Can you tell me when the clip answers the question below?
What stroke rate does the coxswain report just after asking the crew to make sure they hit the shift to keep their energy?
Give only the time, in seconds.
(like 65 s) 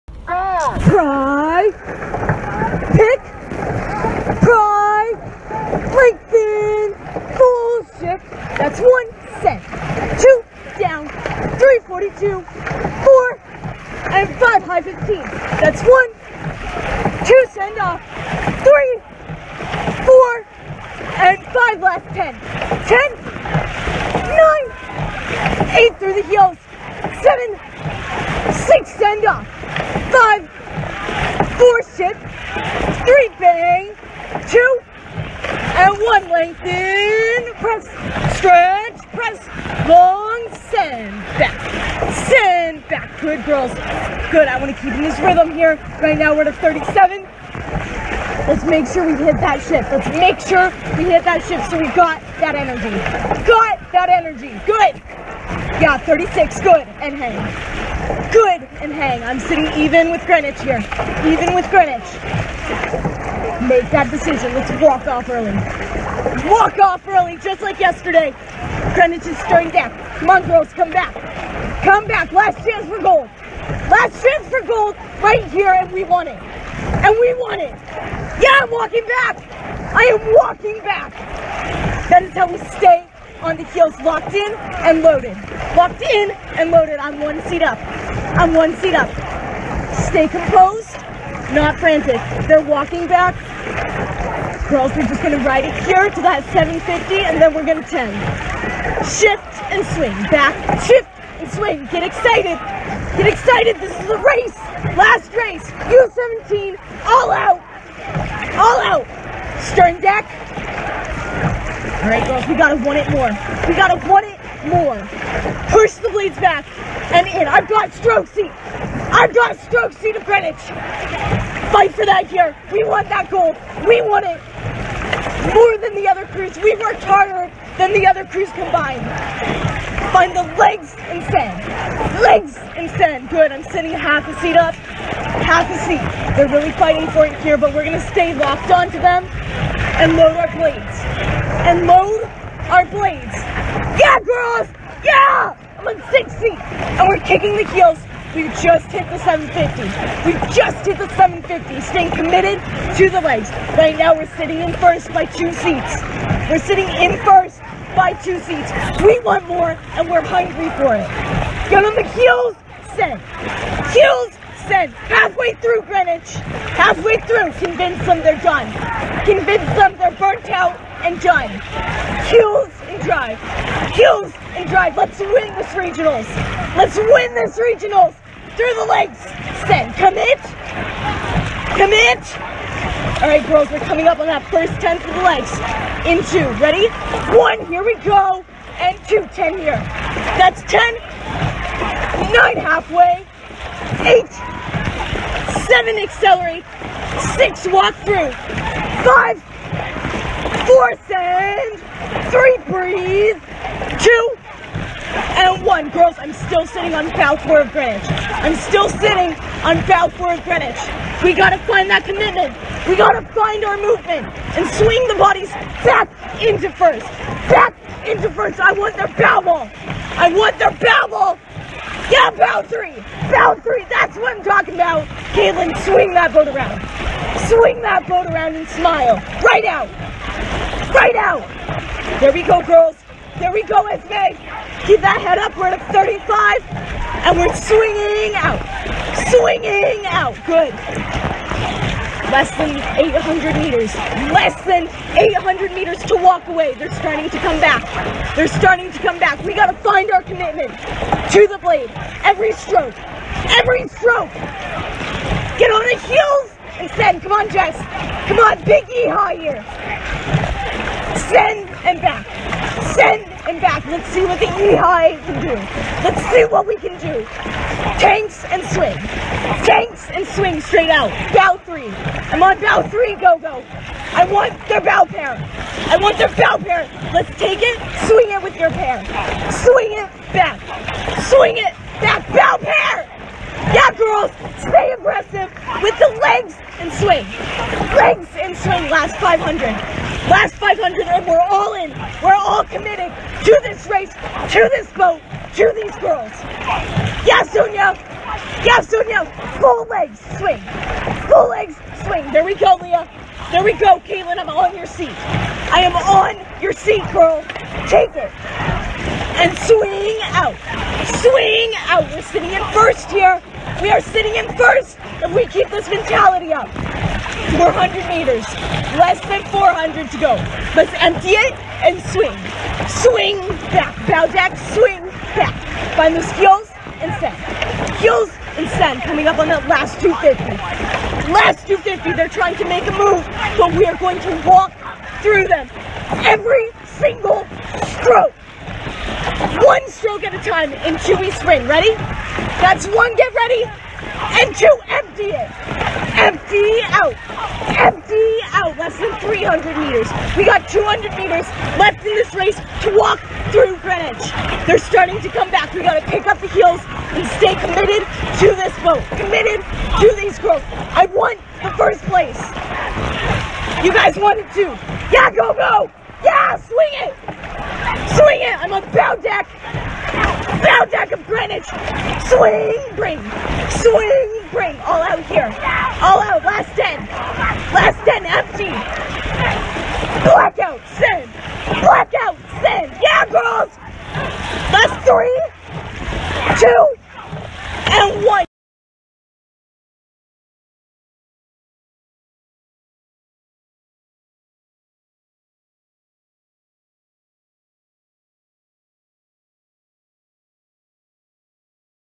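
55 s.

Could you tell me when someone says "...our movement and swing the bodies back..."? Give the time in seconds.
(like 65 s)
213 s.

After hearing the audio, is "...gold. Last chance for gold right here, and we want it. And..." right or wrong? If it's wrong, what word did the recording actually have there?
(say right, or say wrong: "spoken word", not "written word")
right.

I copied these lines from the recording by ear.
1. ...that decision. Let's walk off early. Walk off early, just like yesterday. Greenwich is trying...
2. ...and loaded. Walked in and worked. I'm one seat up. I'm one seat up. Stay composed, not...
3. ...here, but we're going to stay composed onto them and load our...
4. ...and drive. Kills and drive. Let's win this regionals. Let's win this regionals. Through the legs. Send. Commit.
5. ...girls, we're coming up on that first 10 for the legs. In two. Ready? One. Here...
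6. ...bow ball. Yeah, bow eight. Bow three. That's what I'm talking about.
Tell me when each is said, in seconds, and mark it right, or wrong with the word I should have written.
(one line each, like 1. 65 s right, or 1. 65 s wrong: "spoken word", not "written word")
1. 63 s wrong: "starting", not "trying"
2. 84 s wrong: "loaded", not "worked"
3. 137 s wrong: "locked", not "composed"
4. 172 s right
5. 183 s right
6. 220 s wrong: "three", not "eight".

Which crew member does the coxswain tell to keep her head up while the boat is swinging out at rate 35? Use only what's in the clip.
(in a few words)
Esme.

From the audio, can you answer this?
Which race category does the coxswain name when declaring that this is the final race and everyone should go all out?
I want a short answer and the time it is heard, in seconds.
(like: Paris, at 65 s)
U17, at 105 s.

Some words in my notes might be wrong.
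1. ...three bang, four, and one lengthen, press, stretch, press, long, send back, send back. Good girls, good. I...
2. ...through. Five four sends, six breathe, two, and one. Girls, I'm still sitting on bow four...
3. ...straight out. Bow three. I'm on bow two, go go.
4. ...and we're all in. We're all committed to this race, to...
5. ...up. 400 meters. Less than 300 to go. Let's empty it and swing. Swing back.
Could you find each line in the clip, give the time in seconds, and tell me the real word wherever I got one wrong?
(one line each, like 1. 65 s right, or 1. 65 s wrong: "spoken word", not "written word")
1. 33 s wrong: "two", not "four"
2. 198 s wrong: "three", not "six"
3. 270 s wrong: "three", not "two"
4. 291 s right
5. 316 s wrong: "400", not "300".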